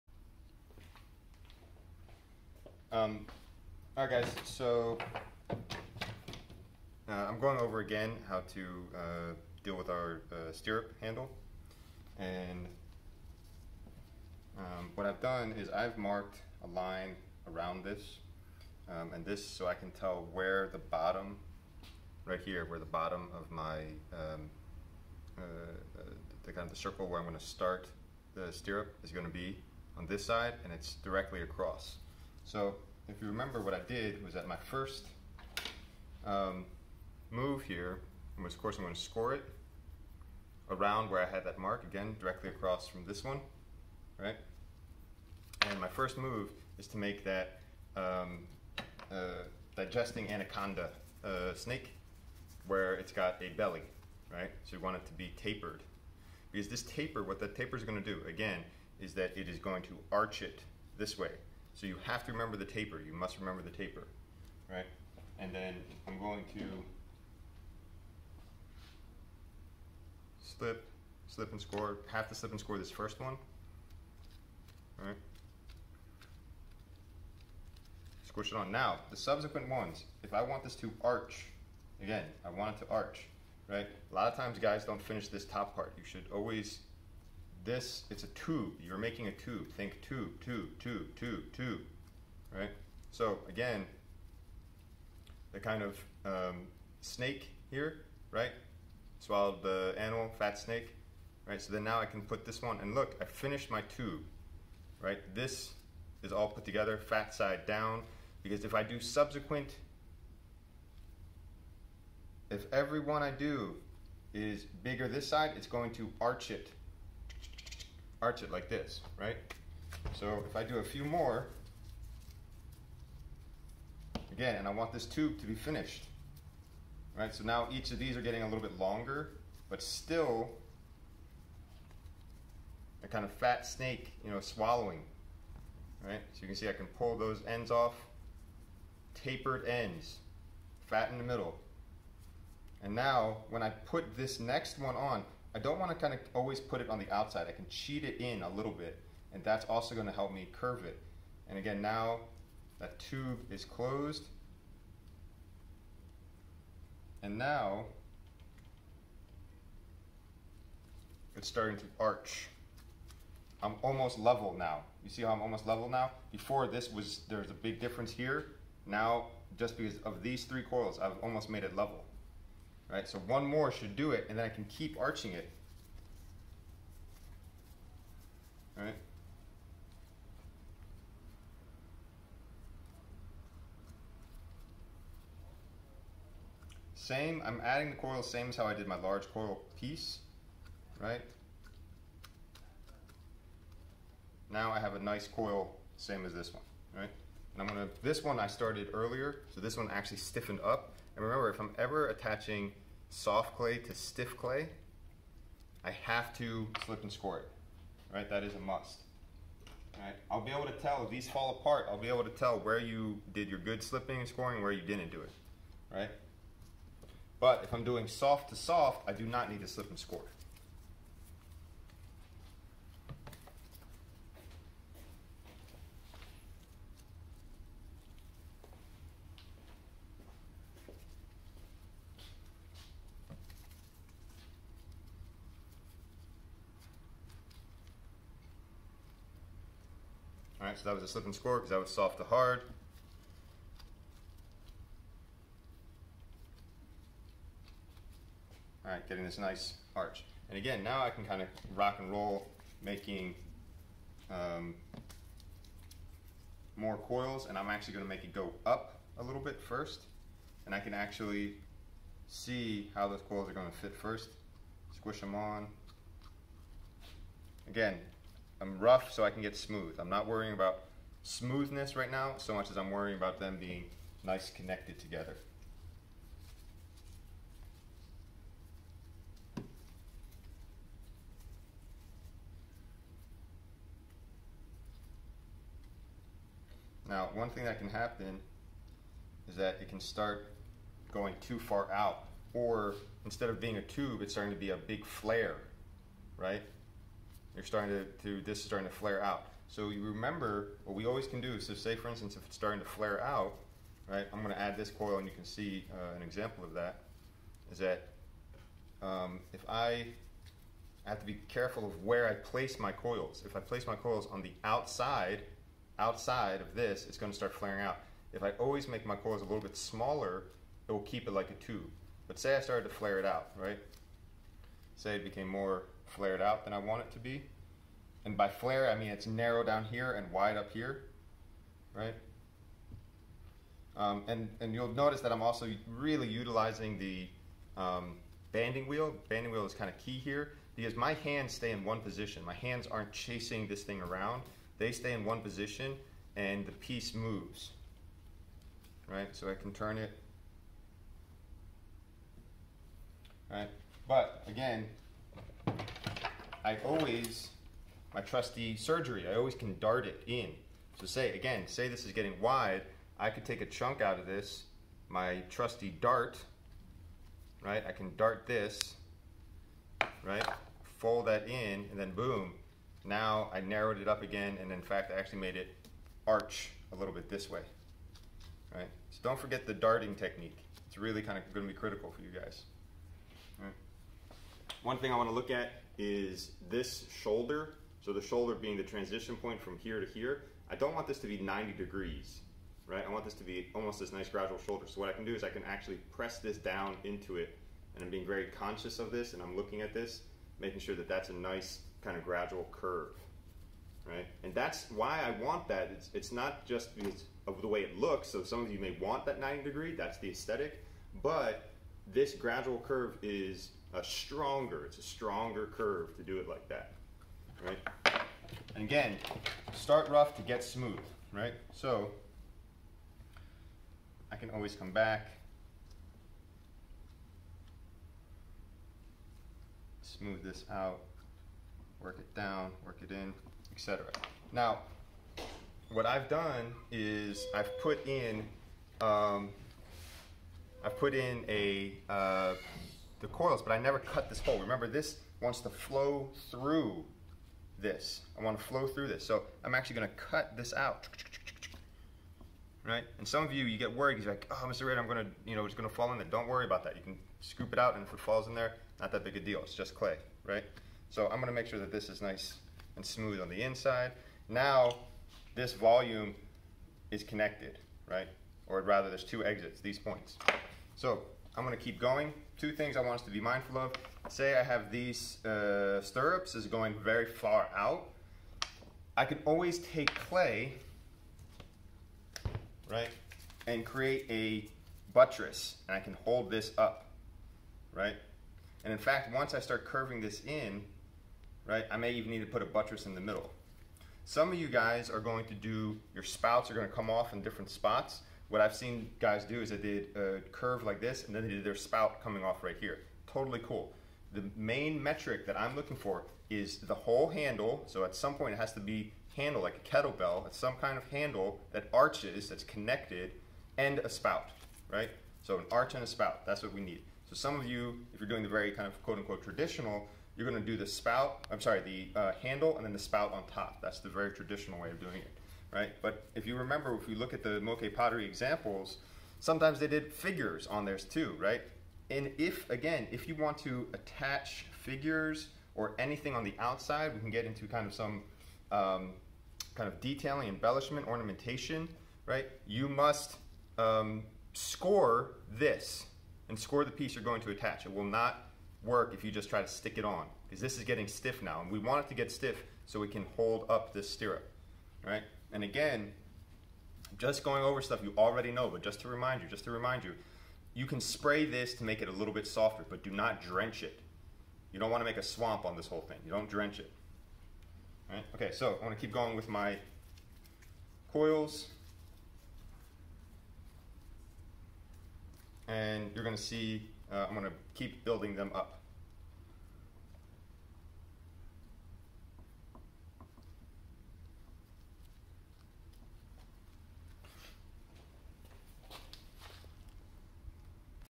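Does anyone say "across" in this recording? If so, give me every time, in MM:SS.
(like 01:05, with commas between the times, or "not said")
00:31, 00:42.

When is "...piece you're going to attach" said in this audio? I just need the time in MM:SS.
09:06.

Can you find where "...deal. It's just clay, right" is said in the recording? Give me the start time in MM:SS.
07:39.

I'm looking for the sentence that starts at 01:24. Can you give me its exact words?
A lot of times guys don't finish this top part.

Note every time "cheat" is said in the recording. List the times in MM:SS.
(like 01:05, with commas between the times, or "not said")
02:27.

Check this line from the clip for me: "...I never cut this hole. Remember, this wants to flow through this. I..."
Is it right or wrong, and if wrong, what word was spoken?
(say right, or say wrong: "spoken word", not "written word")
right.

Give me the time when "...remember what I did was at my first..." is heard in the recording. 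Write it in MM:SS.
00:33.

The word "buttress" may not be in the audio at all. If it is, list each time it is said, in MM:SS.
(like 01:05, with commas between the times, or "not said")
08:05, 08:12.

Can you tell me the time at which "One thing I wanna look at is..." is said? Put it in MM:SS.
06:24.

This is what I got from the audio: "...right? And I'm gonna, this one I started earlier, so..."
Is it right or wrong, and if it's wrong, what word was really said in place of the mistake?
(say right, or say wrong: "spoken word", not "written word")
right.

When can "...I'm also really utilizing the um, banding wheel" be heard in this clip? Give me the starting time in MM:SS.
05:35.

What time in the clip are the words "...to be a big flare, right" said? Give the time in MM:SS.
04:54.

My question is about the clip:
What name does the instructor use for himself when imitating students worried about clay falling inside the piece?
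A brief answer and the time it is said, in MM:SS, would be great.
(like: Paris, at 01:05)
Mr. Raeder, at 07:34.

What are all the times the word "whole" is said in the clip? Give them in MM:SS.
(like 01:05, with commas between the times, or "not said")
08:26, 09:25.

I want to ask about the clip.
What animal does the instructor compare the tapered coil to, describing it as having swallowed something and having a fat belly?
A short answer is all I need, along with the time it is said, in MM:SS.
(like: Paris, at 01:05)
anaconda, at 00:50.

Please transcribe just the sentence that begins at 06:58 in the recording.
And again, start rough to get smooth, right?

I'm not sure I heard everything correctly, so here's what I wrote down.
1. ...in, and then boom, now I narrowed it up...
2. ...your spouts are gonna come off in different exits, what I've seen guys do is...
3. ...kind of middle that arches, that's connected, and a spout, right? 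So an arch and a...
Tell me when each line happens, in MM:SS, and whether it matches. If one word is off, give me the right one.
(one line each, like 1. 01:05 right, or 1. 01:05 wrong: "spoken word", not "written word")
1. 06:11 right
2. 08:16 wrong: "spots", not "exits"
3. 08:30 wrong: "handle", not "middle".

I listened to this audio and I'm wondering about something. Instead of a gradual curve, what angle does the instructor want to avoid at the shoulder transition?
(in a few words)
90 degrees.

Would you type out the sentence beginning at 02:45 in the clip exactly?
You see how I'm almost level now?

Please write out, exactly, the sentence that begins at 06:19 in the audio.
So don't forget the darting technique.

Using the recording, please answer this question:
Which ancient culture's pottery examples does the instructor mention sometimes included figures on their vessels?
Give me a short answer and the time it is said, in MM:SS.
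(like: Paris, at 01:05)
Moche, at 08:47.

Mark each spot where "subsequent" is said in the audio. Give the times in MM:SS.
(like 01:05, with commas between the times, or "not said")
01:19, 01:48.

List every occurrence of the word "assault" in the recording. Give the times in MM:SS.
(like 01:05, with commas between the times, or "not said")
not said.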